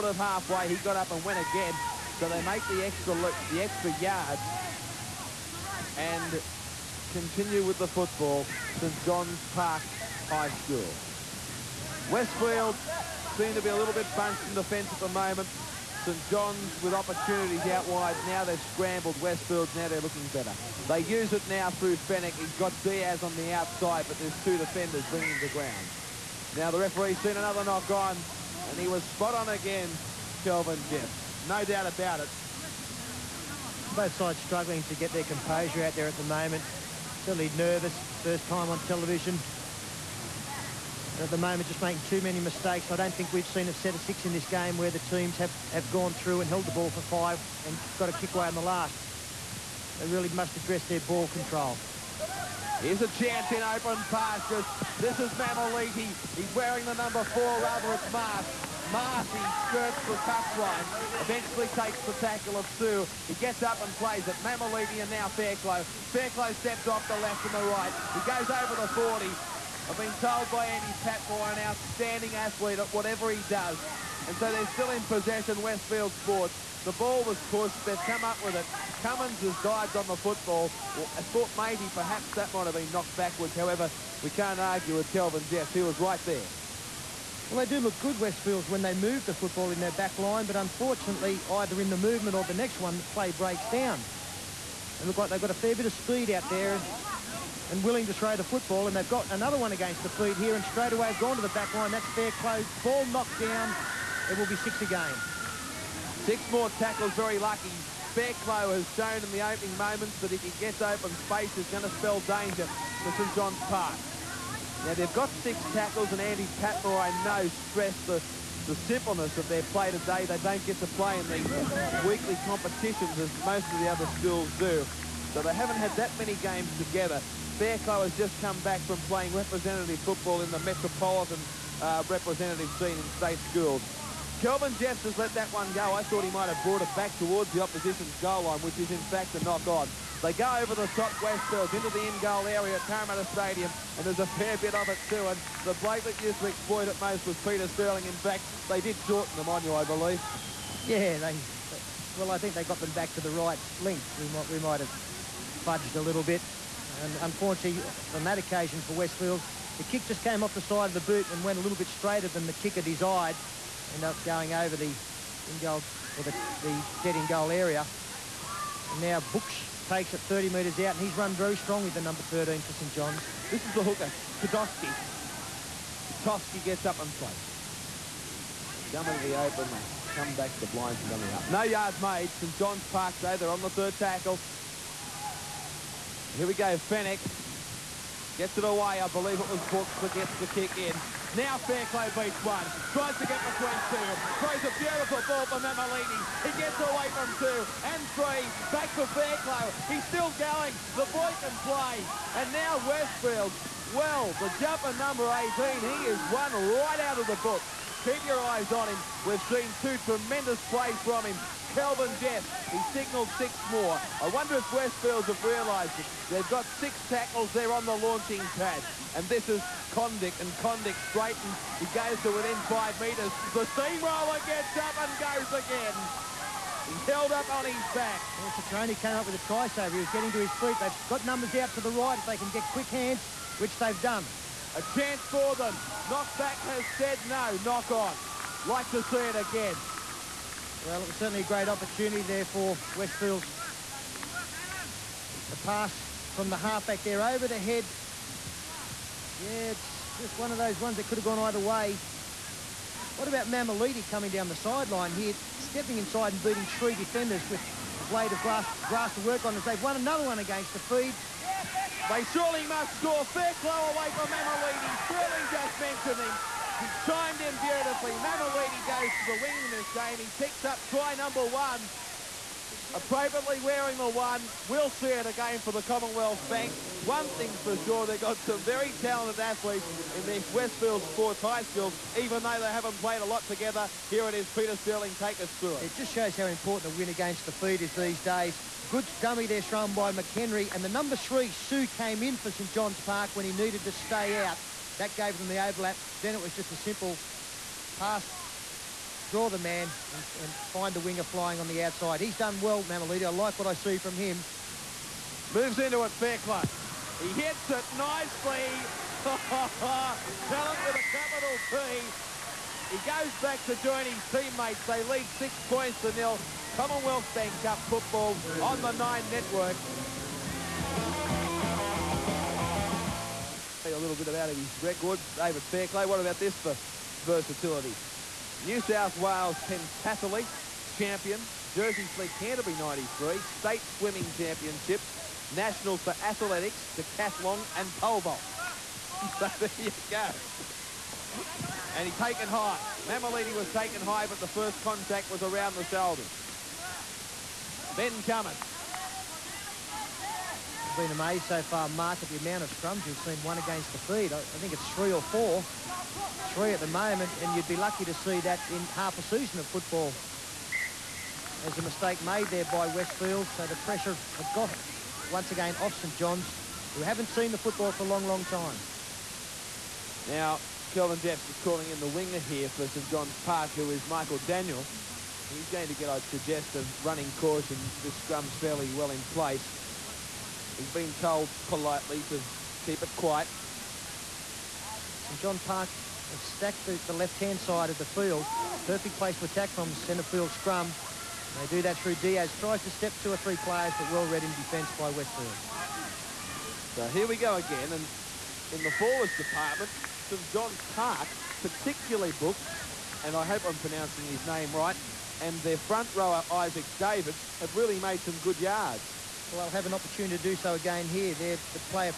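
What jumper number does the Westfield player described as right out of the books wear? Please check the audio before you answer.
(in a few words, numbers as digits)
18.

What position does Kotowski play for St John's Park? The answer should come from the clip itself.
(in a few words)
Hooker.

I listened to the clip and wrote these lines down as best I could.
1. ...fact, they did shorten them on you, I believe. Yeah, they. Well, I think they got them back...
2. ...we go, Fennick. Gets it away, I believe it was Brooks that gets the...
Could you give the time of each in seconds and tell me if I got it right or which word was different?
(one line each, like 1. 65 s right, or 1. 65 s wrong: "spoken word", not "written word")
1. 148 s right
2. 186 s right.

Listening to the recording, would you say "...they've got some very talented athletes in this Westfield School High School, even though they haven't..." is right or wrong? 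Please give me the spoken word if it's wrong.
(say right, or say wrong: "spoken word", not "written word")
wrong: "Sports", not "School".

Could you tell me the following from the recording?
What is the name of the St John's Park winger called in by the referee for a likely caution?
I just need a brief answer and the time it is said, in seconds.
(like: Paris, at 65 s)
Michael Daniel, at 374 s.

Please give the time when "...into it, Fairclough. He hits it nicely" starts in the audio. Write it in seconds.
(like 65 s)
305 s.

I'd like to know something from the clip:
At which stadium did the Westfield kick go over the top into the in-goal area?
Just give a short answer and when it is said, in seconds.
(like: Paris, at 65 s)
Parramatta Stadium, at 142 s.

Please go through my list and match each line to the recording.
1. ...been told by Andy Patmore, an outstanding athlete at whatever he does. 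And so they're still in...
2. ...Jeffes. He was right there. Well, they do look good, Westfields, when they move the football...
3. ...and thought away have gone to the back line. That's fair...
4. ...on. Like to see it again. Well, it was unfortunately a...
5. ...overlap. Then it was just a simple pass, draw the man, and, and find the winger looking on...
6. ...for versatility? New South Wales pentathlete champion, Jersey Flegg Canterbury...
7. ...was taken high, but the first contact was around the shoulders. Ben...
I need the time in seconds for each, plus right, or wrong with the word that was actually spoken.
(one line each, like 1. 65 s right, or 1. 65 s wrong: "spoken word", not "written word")
1. 69 s right
2. 85 s right
3. 100 s wrong: "straight", not "thought"
4. 237 s wrong: "certainly", not "unfortunately"
5. 295 s wrong: "flying", not "looking"
6. 326 s right
7. 343 s right.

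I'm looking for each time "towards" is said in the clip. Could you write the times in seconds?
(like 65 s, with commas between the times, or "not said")
137 s.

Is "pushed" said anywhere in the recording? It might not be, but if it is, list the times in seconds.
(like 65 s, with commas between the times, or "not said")
77 s.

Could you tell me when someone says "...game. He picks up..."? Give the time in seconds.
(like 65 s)
269 s.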